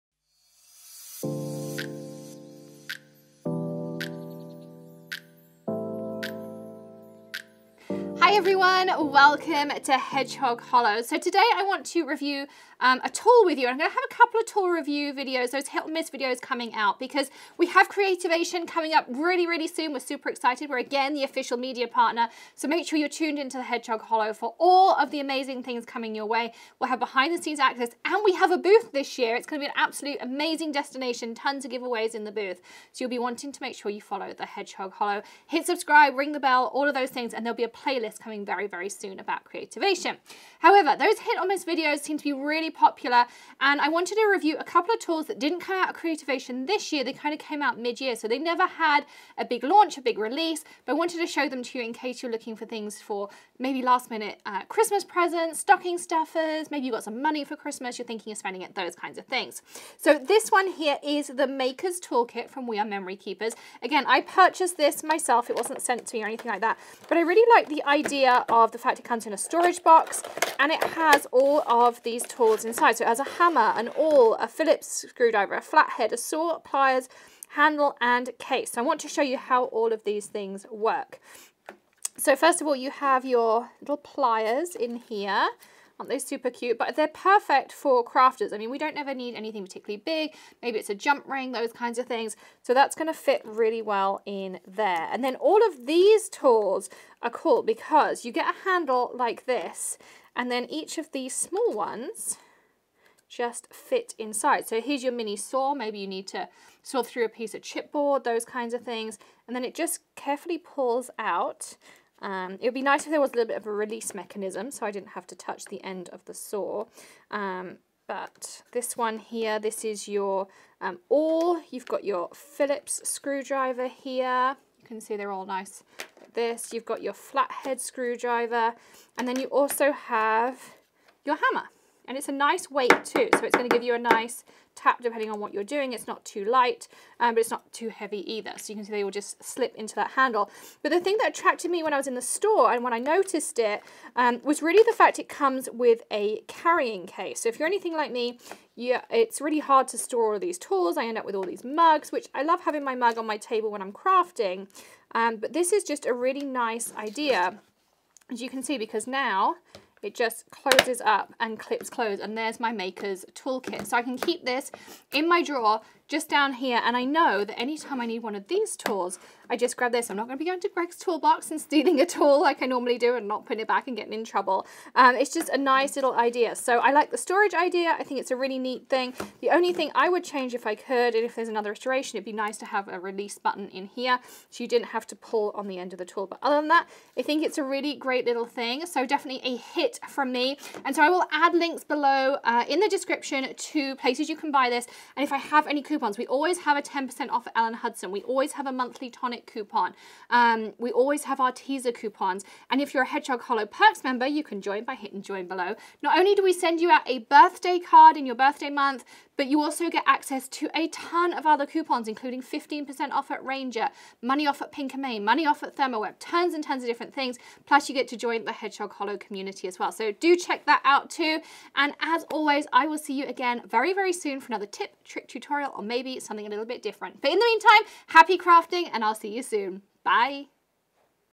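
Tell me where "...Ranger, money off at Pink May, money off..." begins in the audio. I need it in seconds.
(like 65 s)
213 s.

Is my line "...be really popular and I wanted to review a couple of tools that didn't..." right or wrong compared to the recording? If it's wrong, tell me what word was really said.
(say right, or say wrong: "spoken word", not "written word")
right.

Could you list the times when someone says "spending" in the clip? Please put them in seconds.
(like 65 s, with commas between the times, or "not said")
58 s.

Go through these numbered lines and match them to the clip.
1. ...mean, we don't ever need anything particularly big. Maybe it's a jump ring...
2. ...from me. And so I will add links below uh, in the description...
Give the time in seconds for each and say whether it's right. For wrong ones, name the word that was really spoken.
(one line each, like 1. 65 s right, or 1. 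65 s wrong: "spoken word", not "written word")
1. 88 s right
2. 190 s right.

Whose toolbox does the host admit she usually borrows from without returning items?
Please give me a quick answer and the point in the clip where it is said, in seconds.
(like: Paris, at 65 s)
Greg, at 170 s.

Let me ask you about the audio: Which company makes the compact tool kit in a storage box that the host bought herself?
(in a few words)
We Are Memory Keepers.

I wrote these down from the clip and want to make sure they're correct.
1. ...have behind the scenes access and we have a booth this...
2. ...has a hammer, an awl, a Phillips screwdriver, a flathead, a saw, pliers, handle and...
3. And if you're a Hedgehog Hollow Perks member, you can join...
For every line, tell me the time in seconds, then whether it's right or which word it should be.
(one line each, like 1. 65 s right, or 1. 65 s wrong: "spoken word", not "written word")
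1. 26 s right
2. 73 s right
3. 202 s right.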